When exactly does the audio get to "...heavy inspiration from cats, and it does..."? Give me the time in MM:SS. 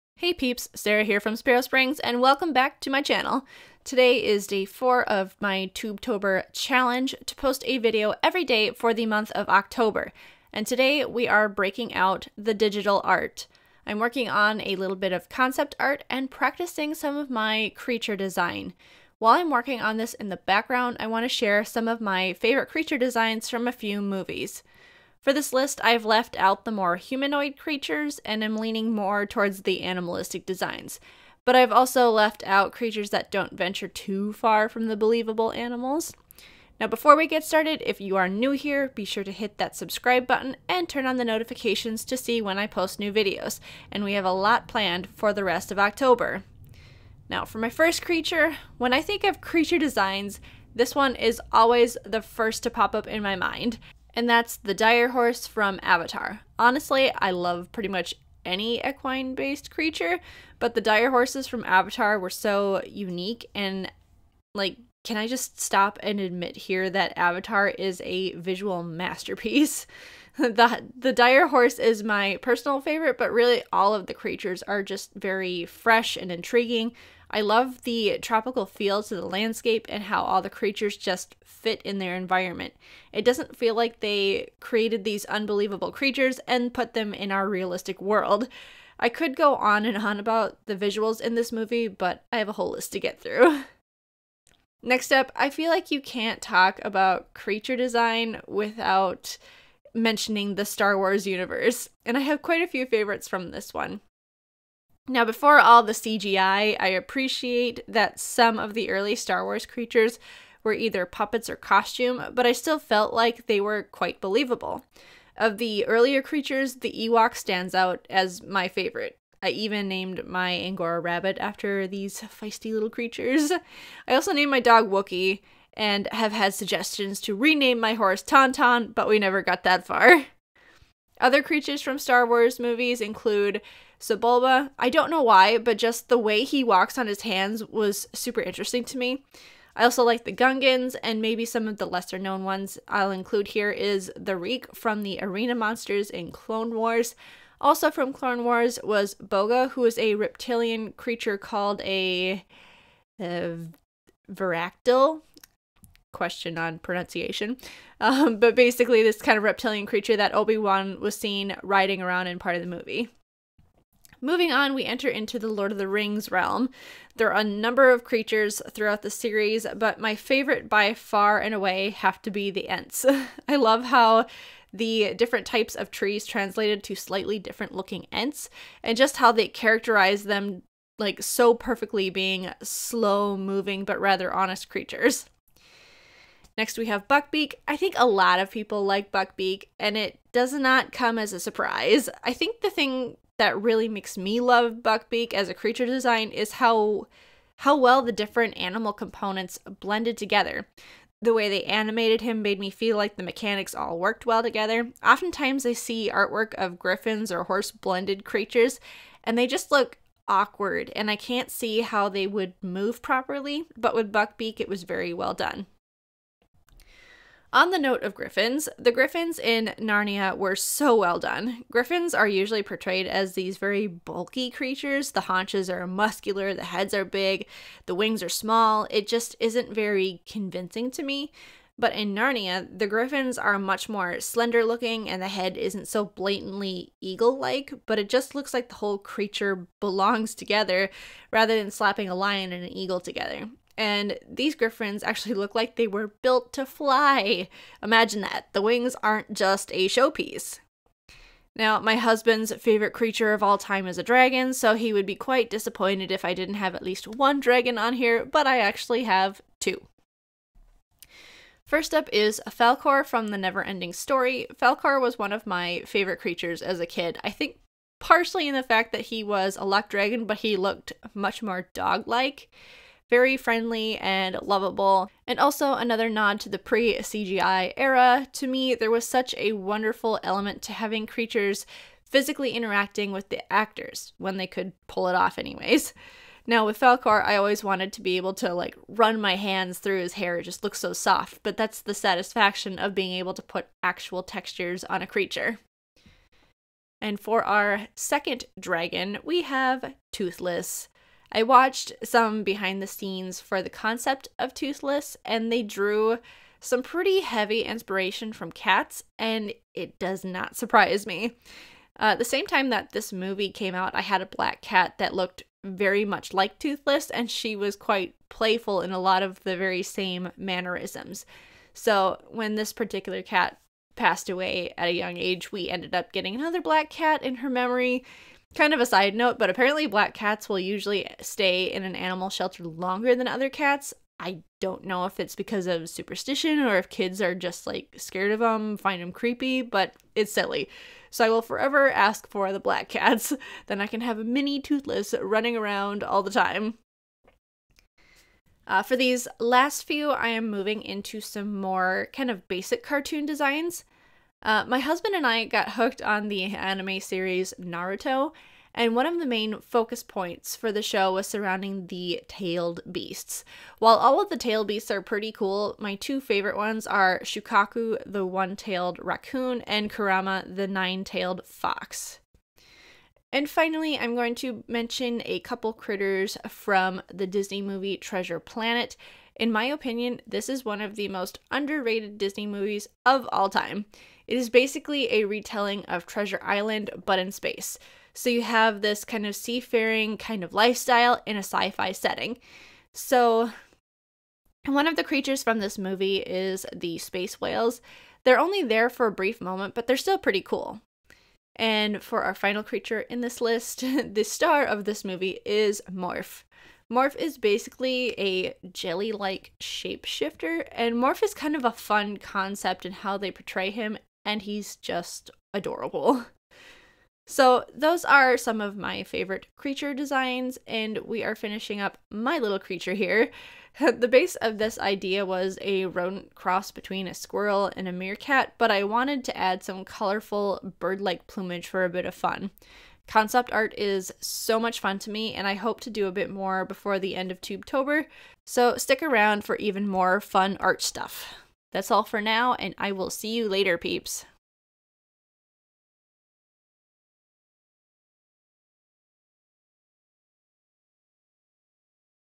05:07.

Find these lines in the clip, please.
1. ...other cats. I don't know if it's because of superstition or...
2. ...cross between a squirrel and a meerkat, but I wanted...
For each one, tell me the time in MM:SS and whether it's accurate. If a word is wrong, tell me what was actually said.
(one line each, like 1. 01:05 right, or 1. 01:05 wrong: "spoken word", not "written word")
1. 05:33 right
2. 07:06 right.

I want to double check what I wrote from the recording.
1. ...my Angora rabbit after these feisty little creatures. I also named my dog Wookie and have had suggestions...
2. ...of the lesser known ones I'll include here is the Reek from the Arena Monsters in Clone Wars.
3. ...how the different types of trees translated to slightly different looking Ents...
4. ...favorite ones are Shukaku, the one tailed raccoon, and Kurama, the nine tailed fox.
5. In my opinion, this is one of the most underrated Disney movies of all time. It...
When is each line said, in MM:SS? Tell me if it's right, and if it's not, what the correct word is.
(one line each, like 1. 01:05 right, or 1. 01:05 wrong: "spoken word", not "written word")
1. 02:00 right
2. 02:21 right
3. 02:53 right
4. 06:06 right
5. 06:19 right.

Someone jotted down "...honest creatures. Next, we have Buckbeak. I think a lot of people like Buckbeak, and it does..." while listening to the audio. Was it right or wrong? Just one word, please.
right.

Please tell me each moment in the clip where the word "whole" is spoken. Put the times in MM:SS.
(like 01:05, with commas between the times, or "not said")
01:32, 03:58.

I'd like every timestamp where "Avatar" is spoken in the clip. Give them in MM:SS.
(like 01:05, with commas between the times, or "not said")
00:55, 01:01, 01:07.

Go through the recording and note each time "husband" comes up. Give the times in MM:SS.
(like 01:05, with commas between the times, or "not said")
04:11, 05:54.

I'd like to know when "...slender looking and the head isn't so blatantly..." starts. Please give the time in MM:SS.
03:54.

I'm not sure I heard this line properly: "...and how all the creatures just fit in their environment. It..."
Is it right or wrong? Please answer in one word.
right.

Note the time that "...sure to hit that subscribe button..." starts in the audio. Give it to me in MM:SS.
00:39.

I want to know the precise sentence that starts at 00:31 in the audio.
But I've also left out creatures that don't venture too far from the believable animals.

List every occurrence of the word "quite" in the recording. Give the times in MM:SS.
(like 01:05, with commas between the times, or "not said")
01:42, 01:53, 04:15, 05:17.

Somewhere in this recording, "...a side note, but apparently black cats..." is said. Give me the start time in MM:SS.
05:28.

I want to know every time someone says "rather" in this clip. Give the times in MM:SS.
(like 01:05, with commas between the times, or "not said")
03:03, 04:01.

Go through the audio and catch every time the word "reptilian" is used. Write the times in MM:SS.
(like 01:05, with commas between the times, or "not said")
02:30, 02:39.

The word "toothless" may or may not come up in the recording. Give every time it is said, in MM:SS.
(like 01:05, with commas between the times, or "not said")
05:00, 05:04, 05:16, 05:44.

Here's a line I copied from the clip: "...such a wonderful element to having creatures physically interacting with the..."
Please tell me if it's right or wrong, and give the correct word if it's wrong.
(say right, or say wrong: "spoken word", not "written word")
right.